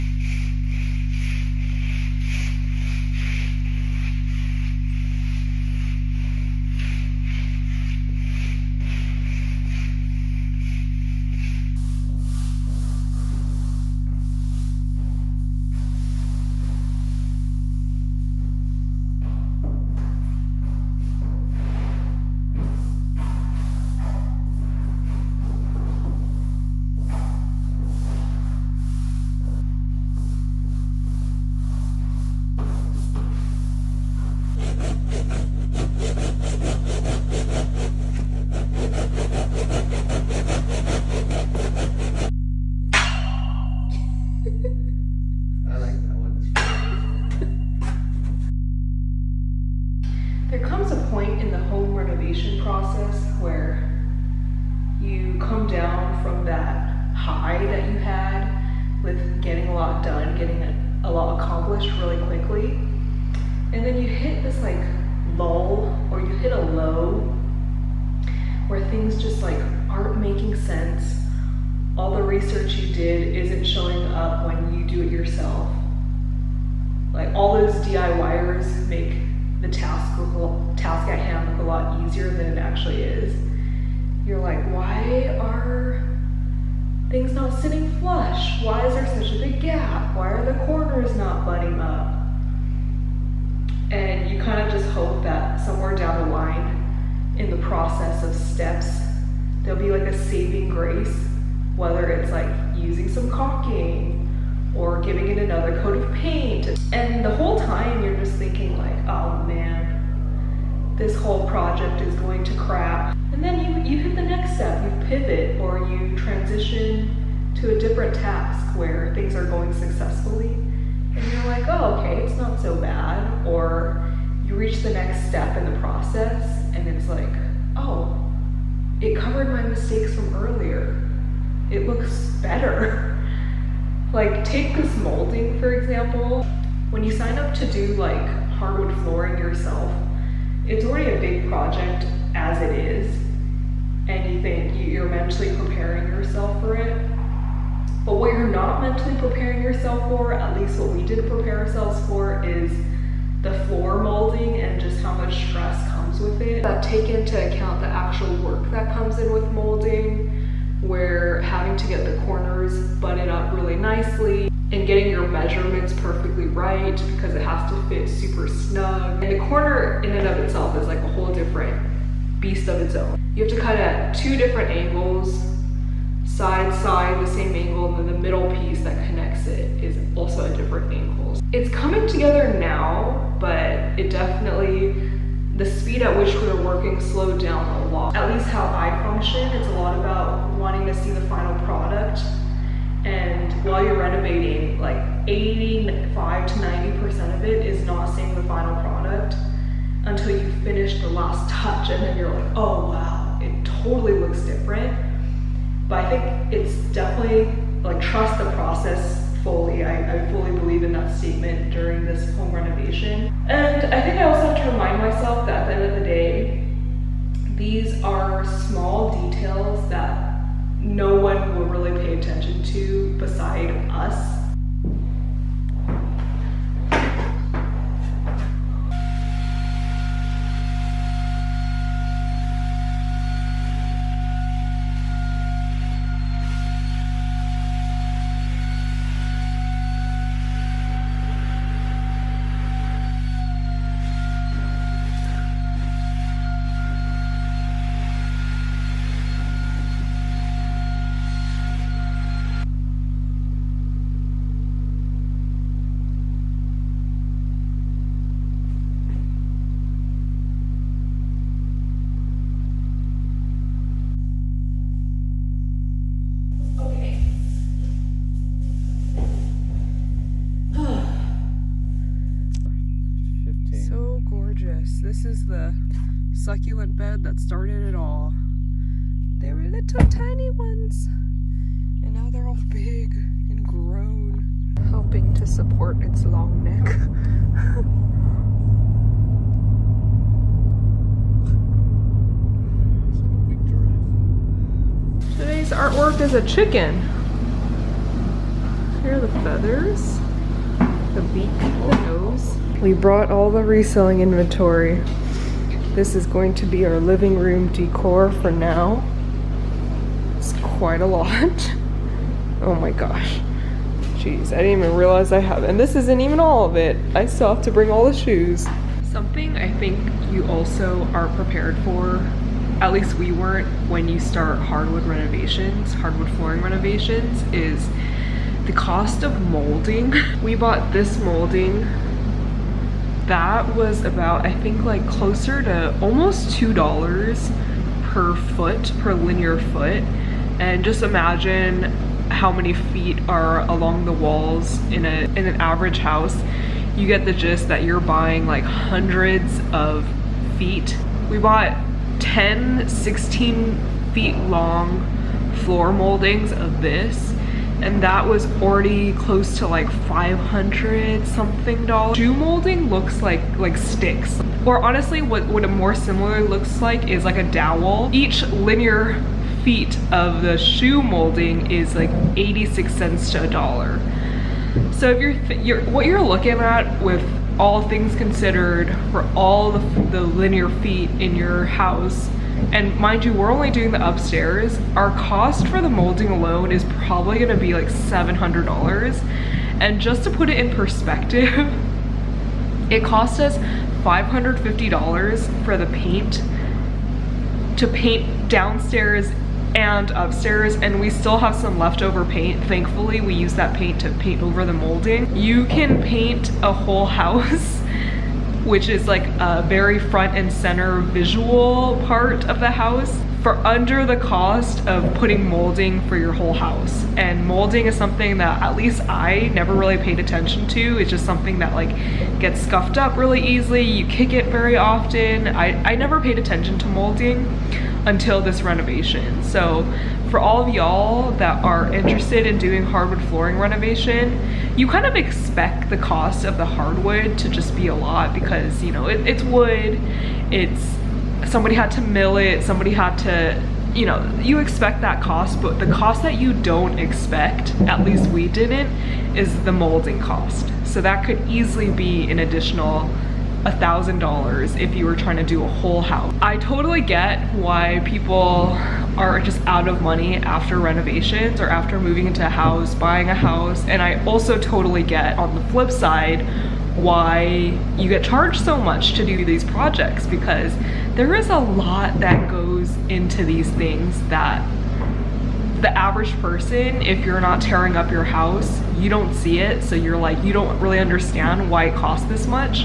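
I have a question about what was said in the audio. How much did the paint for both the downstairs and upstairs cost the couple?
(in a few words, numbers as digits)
$550.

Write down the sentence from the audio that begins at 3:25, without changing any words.
But I think it's definitely like trust the process fully.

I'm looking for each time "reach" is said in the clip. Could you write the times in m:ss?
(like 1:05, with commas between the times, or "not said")
2:04.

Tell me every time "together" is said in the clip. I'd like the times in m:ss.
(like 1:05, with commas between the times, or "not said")
3:02.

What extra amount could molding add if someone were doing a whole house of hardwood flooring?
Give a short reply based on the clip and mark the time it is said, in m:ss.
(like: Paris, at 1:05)
$1,000, at 7:33.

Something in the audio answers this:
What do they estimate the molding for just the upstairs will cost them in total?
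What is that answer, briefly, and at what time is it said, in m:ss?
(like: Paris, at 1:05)
$700, at 6:27.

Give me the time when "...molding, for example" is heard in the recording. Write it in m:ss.
2:14.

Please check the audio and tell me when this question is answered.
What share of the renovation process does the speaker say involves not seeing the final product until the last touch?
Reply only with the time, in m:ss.
3:15.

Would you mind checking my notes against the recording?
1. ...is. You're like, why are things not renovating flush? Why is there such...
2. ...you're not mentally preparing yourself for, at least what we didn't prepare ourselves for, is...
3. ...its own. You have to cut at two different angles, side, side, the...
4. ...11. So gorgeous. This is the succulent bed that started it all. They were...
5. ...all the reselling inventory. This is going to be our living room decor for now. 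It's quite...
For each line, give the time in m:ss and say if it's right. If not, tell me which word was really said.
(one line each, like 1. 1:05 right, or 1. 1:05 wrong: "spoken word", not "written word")
1. 1:23 wrong: "sitting", not "renovating"
2. 2:28 right
3. 2:52 right
4. 4:33 wrong: "15", not "11"
5. 5:03 right.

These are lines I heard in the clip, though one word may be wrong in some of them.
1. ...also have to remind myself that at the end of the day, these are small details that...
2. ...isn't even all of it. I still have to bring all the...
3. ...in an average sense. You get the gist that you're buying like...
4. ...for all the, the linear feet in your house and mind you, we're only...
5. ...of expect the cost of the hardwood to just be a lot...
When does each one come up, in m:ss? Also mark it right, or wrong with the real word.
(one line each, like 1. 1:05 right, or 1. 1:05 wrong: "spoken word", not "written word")
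1. 3:34 right
2. 5:15 right
3. 5:45 wrong: "house", not "sense"
4. 6:19 right
5. 7:15 right.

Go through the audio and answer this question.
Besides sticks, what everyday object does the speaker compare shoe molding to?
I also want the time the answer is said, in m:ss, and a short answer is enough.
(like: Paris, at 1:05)
A dowel, at 6:07.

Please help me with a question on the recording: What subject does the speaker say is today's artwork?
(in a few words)
A chicken.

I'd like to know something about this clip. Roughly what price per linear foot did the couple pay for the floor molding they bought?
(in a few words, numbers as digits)
Almost $2.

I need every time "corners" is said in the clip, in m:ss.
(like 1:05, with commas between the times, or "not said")
1:30, 2:42, 2:49.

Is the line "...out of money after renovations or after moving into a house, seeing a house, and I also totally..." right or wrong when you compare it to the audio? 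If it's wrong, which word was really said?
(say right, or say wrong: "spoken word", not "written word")
wrong: "buying", not "seeing".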